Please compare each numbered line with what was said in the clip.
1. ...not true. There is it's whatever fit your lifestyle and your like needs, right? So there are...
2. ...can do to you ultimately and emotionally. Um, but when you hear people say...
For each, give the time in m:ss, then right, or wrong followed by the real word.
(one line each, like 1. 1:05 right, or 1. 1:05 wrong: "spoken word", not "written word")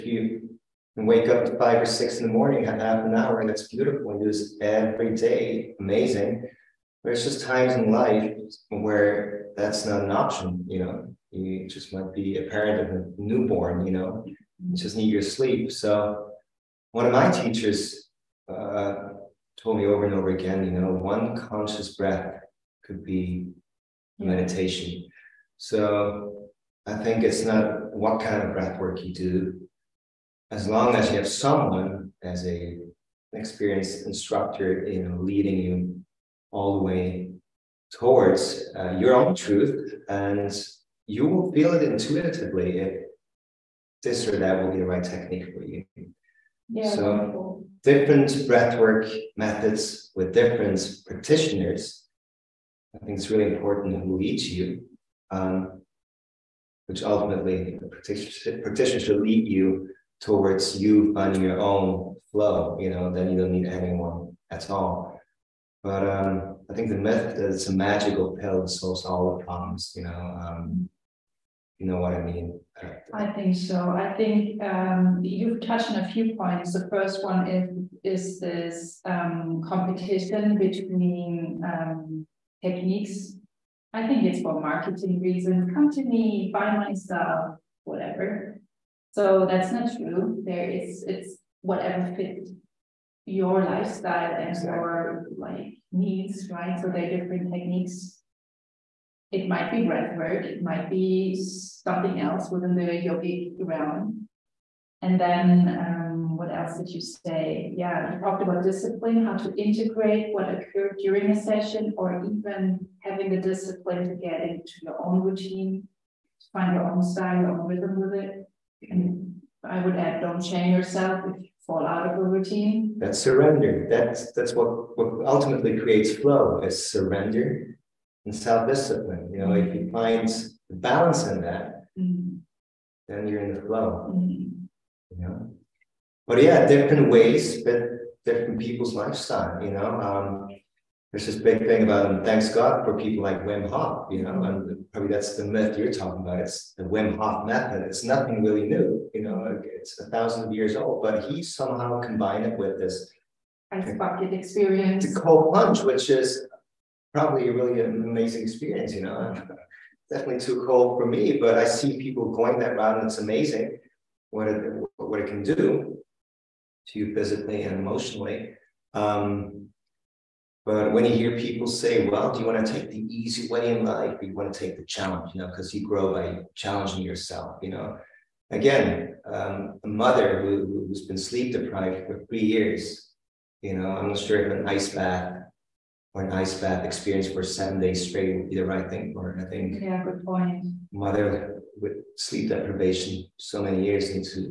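1. 1:29 right
2. 2:45 wrong: "physically", not "ultimately".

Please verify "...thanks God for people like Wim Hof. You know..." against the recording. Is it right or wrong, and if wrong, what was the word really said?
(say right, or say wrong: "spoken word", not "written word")
right.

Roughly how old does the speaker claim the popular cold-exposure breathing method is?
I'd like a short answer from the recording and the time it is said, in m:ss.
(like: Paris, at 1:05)
A thousand years, at 2:29.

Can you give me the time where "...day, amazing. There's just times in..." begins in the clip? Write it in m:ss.
0:05.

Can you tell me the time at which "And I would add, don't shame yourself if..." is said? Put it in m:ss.
1:58.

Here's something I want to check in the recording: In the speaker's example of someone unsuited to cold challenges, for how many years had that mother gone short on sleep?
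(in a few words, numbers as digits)
3.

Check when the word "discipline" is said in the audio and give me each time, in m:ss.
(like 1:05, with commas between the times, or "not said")
1:48, 1:53, 2:08.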